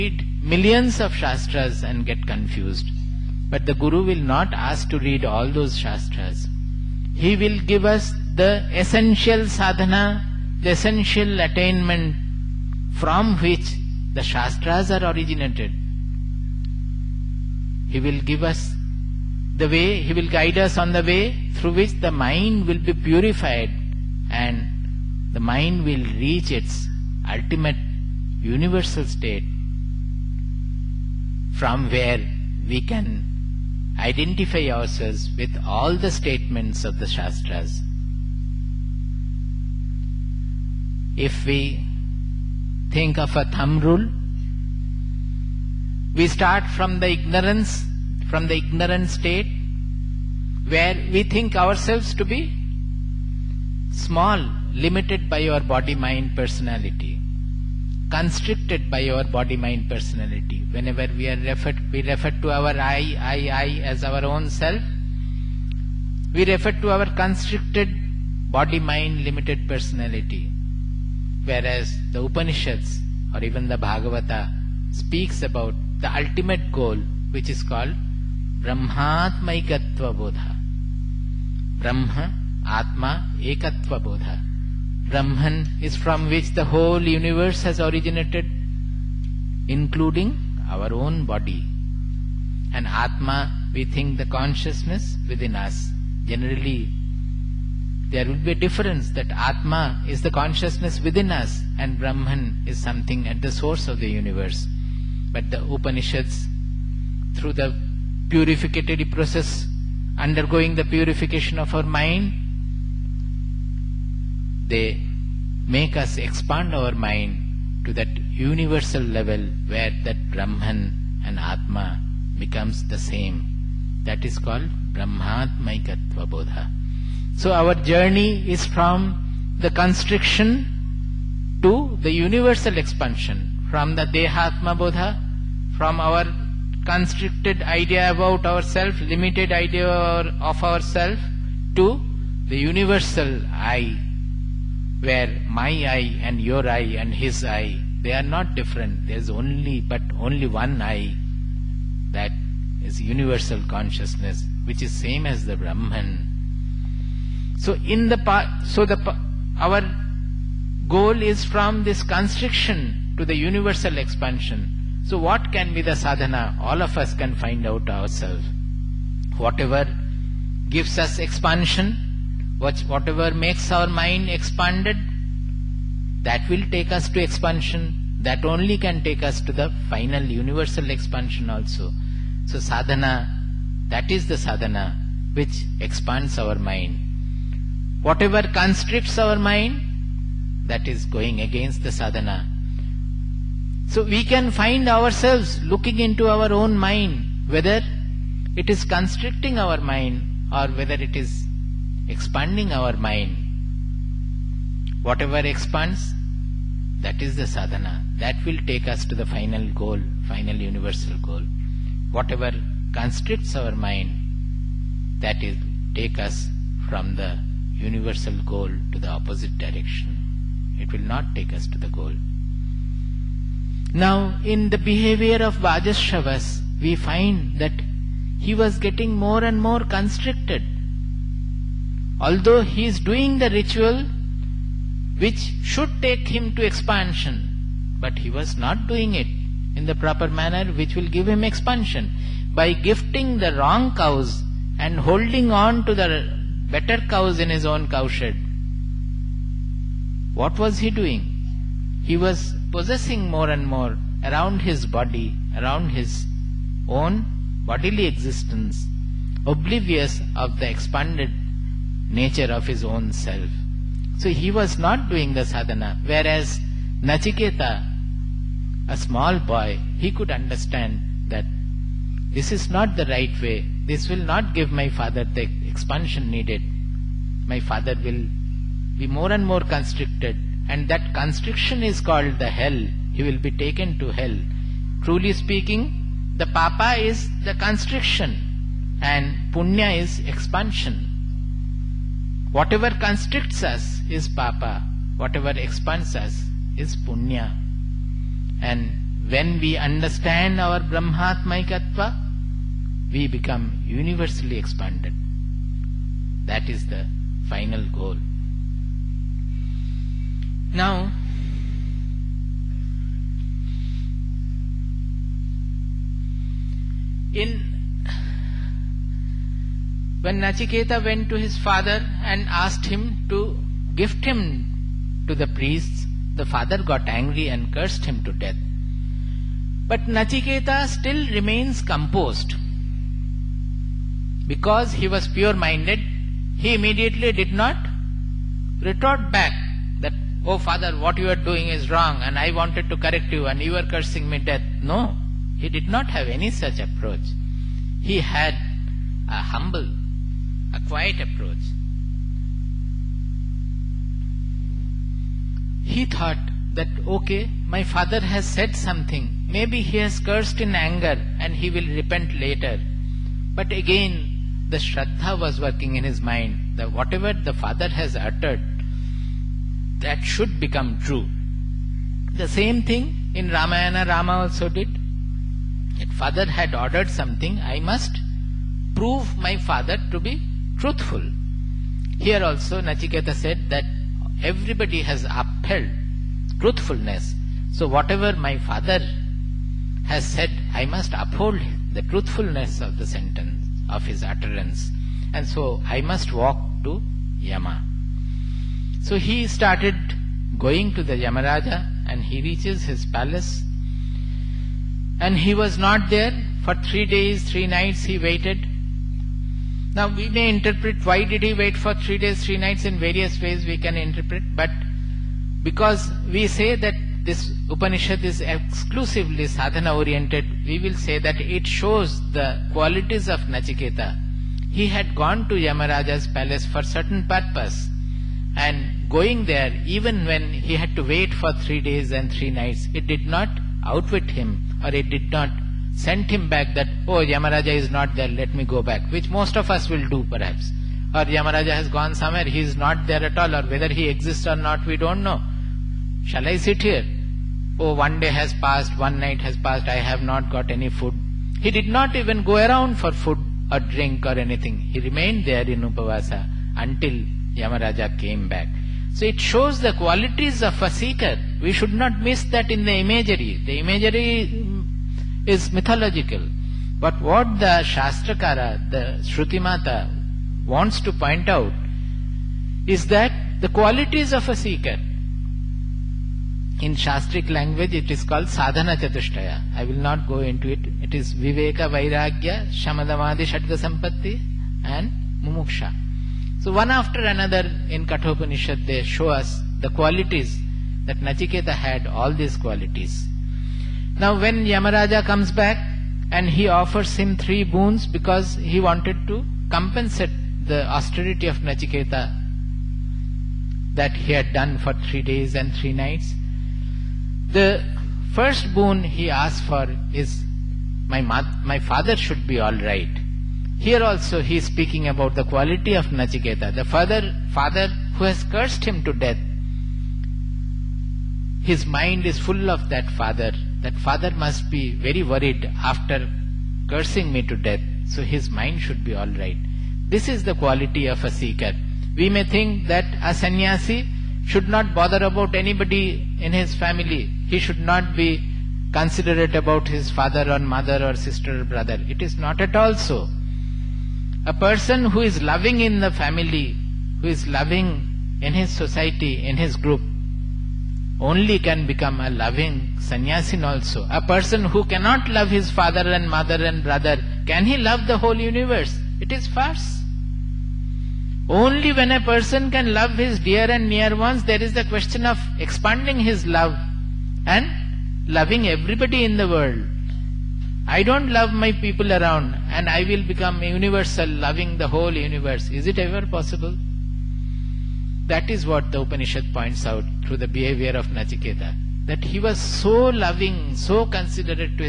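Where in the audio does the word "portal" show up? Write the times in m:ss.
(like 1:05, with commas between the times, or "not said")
not said.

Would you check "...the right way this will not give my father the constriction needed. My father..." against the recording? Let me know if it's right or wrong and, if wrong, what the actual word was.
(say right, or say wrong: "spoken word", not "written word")
wrong: "expansion", not "constriction".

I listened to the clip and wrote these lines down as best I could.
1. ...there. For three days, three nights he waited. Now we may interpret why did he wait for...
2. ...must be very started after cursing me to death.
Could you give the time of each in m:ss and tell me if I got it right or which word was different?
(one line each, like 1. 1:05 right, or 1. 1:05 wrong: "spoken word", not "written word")
1. 6:46 right
2. 8:44 wrong: "worried", not "started".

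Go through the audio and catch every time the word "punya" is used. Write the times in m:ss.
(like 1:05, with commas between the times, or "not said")
4:49, 4:56.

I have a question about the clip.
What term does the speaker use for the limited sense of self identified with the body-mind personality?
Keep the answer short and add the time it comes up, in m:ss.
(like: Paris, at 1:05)
Dehatma Bodha, at 2:14.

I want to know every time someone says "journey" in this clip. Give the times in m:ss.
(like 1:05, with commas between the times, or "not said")
2:07.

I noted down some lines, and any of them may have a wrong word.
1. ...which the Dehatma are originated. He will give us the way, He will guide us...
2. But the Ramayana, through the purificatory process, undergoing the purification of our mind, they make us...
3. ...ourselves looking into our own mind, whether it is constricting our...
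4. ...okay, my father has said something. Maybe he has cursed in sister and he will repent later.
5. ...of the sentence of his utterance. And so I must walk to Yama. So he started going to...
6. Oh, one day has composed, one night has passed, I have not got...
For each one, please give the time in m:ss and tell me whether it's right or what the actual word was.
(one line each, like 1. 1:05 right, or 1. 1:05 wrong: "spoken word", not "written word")
1. 0:13 wrong: "Shastras", not "Dehatma"
2. 1:45 wrong: "Upanishads", not "Ramayana"
3. 3:14 right
4. 5:57 wrong: "anger", not "sister"
5. 6:32 right
6. 7:27 wrong: "passed", not "composed".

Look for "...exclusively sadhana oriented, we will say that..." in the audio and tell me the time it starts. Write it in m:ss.
6:58.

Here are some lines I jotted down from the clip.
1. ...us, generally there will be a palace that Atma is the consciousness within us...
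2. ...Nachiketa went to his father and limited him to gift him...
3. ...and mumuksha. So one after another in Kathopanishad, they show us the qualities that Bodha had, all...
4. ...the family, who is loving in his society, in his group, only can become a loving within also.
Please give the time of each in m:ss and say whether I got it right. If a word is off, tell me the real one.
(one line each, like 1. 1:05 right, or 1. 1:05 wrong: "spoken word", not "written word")
1. 1:35 wrong: "difference", not "palace"
2. 5:20 wrong: "asked", not "limited"
3. 8:04 wrong: "Nachiketa", not "Bodha"
4. 9:05 wrong: "sannyasin", not "within".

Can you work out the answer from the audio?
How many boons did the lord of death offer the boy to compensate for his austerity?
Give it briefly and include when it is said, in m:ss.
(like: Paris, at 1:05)
3, at 8:17.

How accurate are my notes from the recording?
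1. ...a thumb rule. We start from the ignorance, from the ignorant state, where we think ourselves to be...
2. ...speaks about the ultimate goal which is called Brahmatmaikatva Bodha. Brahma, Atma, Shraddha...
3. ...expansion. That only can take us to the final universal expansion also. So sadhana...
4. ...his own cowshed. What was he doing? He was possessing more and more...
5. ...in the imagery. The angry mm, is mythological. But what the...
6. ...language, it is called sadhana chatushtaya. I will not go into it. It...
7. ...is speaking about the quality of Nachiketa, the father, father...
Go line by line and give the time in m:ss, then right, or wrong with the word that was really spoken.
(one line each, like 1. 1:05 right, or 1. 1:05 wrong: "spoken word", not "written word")
1. 0:43 right
2. 1:14 wrong: "Ekatva", not "Shraddha"
3. 2:57 right
4. 4:07 right
5. 7:42 wrong: "imagery", not "angry"
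6. 7:57 right
7. 8:34 right.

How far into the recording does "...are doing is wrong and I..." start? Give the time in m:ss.
5:41.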